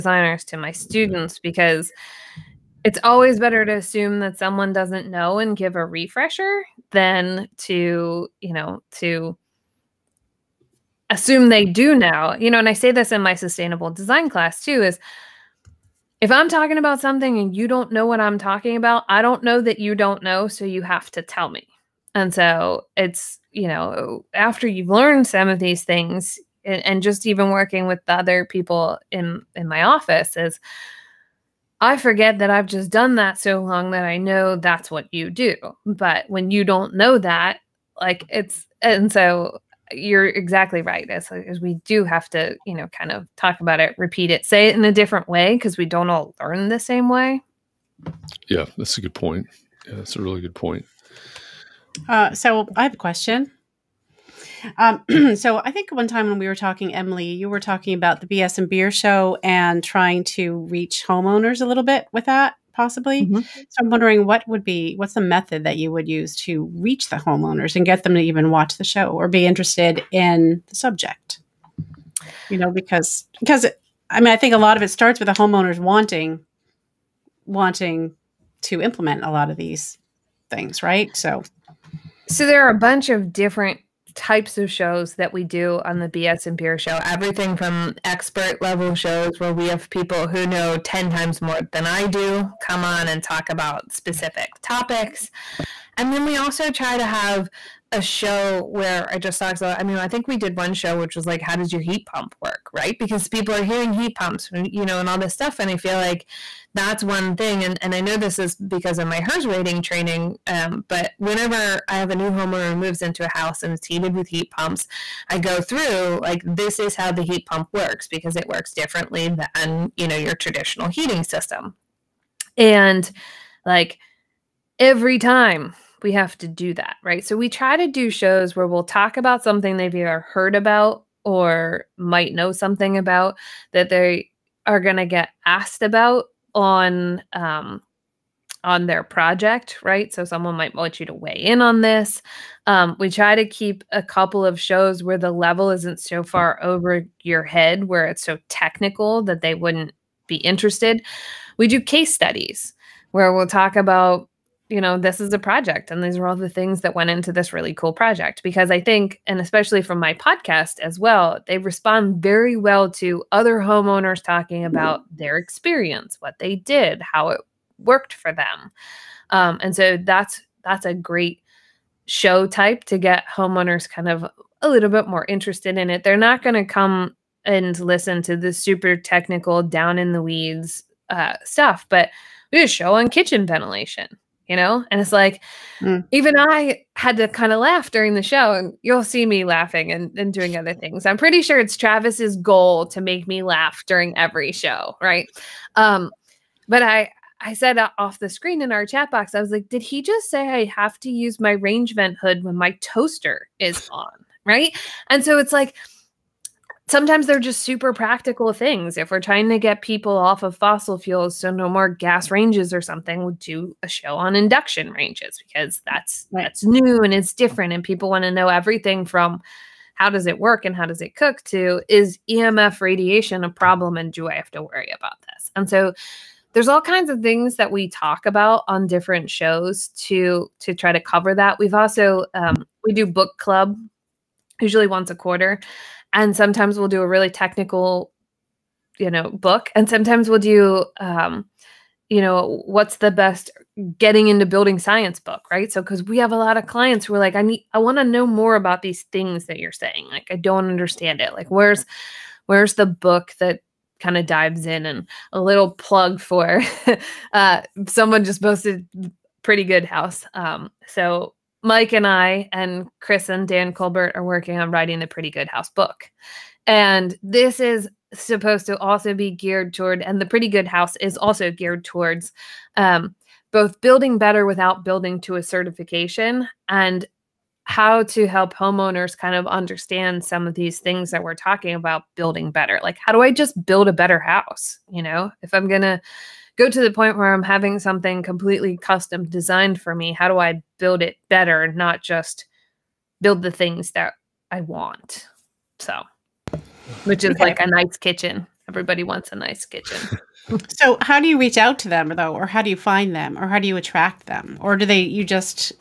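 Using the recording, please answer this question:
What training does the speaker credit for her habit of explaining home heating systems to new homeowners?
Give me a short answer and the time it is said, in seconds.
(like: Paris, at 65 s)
HERS rating training, at 109 s.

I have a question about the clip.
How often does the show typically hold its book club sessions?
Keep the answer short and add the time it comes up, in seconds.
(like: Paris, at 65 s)
once a quarter, at 234 s.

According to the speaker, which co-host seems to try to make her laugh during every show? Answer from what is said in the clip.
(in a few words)
Travis.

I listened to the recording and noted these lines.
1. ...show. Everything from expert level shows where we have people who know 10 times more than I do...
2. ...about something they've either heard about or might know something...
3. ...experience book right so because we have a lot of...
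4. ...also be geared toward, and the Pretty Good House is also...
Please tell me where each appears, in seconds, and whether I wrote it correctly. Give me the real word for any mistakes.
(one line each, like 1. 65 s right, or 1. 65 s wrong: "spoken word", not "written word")
1. 86 s right
2. 129 s right
3. 244 s wrong: "science", not "experience"
4. 268 s right.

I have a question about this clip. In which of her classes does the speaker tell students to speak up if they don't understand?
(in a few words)
sustainable design.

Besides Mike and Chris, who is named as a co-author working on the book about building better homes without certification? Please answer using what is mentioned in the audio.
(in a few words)
Dan Kolbert.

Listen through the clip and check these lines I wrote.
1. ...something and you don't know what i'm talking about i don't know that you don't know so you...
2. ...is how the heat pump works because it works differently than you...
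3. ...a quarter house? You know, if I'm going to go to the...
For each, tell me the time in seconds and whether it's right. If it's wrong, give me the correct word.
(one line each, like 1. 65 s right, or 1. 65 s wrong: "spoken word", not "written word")
1. 16 s right
2. 116 s right
3. 283 s wrong: "better", not "quarter".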